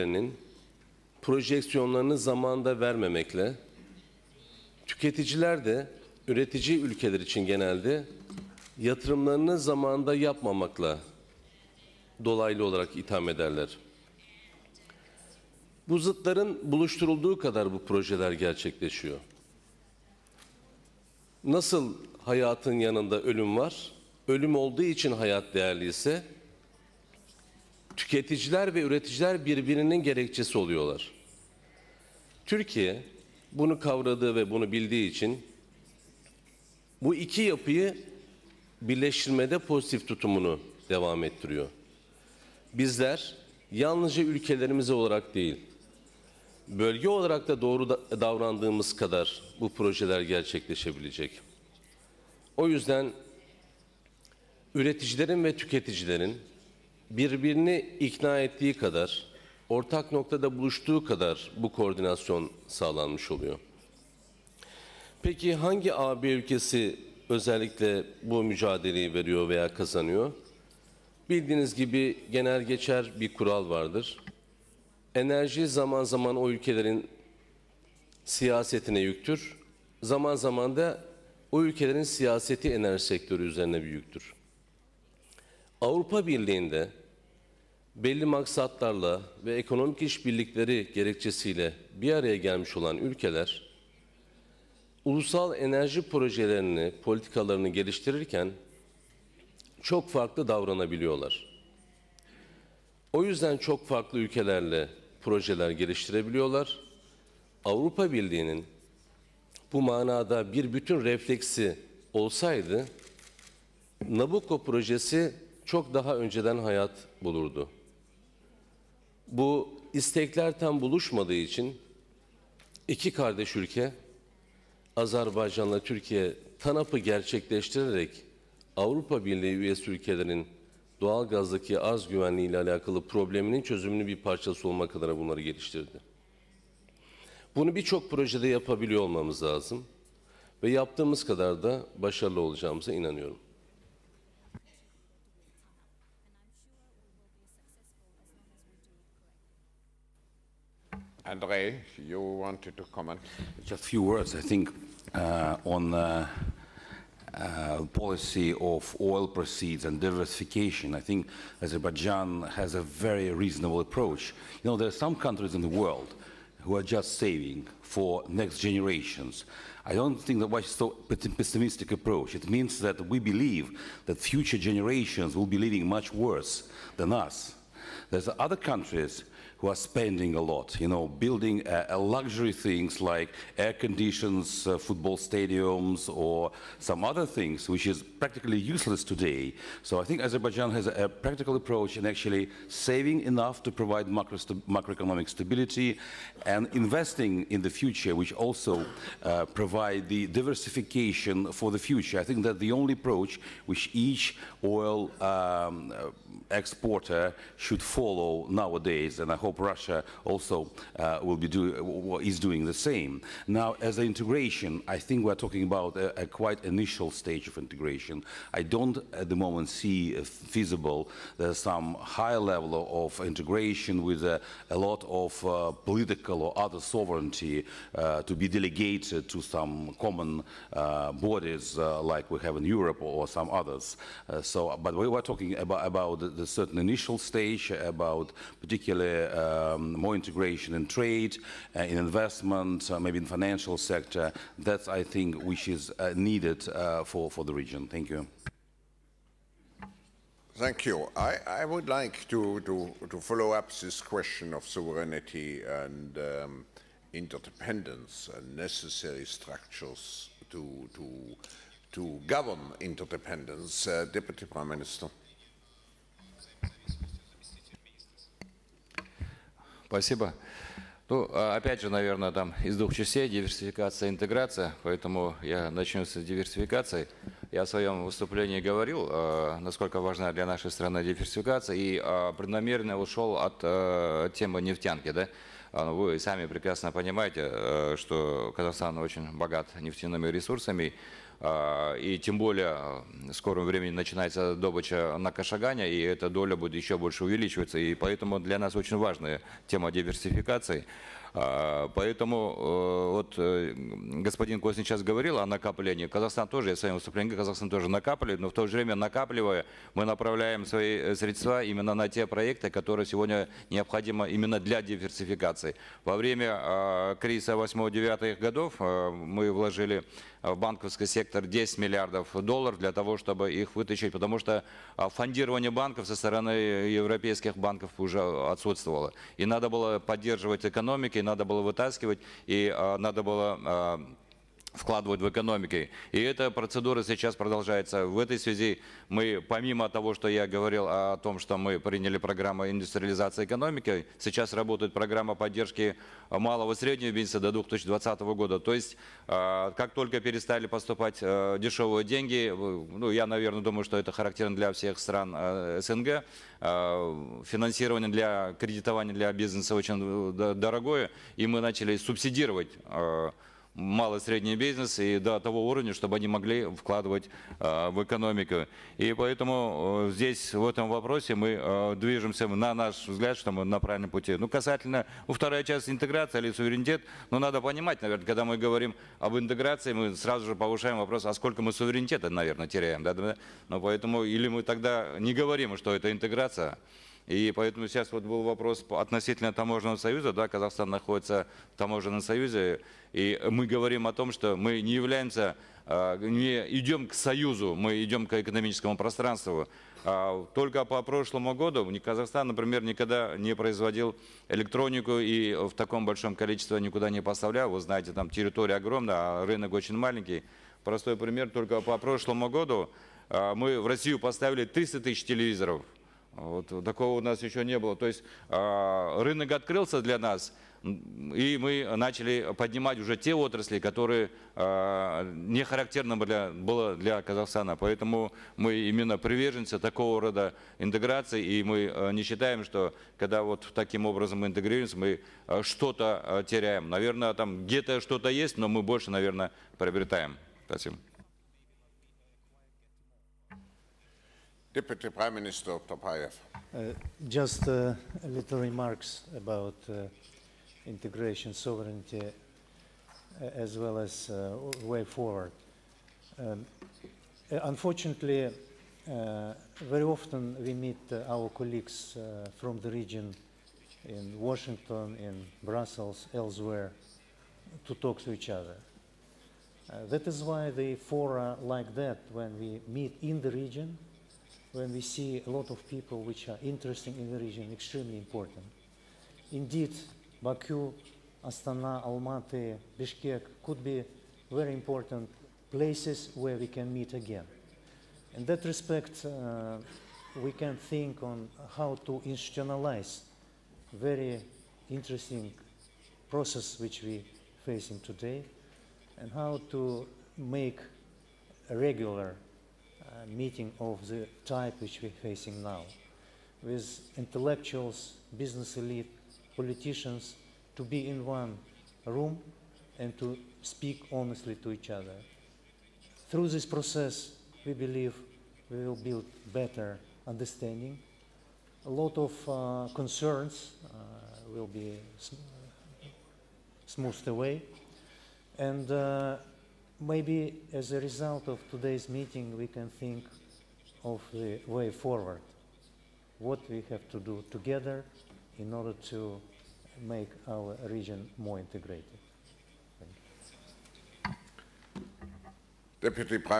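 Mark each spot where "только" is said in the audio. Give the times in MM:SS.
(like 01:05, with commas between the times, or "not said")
05:49, 06:40, 06:51.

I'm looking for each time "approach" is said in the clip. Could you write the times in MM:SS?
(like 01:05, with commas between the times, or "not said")
02:43, 02:51, 03:11, 03:22.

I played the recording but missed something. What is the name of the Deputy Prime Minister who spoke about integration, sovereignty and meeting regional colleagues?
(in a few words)
Otorbaev.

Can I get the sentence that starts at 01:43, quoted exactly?
O yüzden çok farklı ülkelerle projeler geliştirebiliyorlar.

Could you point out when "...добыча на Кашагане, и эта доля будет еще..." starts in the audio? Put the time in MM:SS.
04:54.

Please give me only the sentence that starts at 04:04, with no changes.
That's, I think, which is uh, needed uh, for, for the region.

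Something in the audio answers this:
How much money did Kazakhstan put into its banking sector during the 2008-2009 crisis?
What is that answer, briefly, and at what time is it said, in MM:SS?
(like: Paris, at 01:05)
10 billion dollars, at 05:21.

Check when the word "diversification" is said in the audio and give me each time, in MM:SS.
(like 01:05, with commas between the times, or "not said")
02:39, 03:20.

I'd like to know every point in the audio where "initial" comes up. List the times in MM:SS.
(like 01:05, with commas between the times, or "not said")
03:36, 03:56.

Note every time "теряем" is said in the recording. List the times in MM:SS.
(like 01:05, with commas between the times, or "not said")
06:22, 07:16.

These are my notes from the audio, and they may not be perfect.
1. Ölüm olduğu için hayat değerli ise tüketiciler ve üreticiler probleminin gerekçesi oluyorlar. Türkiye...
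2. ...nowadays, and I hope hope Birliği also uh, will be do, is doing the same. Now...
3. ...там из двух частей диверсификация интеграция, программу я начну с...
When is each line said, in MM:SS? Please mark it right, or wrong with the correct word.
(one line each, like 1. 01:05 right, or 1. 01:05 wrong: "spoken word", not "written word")
1. 00:24 wrong: "birbirinin", not "probleminin"
2. 03:28 wrong: "Russia", not "Birliği"
3. 04:32 wrong: "поэтому", not "программу".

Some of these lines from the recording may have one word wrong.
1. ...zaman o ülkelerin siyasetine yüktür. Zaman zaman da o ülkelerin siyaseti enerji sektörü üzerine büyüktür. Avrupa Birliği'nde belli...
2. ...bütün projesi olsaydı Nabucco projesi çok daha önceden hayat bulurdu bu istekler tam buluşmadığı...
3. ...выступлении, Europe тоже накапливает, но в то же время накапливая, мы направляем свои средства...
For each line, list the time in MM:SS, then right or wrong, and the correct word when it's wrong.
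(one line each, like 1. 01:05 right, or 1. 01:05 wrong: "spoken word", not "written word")
1. 01:16 right
2. 01:50 wrong: "refleksi", not "projesi"
3. 05:06 wrong: "Казахстан", not "Europe".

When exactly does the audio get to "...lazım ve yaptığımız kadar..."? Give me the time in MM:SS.
02:19.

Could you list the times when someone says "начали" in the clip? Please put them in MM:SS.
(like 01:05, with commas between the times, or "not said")
06:01, 07:01.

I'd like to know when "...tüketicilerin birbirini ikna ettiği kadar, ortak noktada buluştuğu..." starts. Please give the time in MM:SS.
00:55.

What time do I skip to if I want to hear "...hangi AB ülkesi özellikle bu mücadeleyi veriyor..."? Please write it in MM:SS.
01:05.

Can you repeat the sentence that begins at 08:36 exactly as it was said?
Through this process, we believe we will build better understanding.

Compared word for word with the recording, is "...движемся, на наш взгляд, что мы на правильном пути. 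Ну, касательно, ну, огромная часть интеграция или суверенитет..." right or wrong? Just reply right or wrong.
wrong.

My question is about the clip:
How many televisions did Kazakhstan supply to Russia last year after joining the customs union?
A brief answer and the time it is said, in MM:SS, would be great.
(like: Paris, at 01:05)
300,000, at 06:54.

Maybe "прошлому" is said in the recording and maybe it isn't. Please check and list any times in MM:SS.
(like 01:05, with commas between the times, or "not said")
06:41, 06:51.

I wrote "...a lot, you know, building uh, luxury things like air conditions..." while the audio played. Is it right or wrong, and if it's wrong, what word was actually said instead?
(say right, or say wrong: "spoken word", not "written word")
right.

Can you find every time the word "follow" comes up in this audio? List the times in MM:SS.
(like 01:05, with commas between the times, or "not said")
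03:27, 04:13.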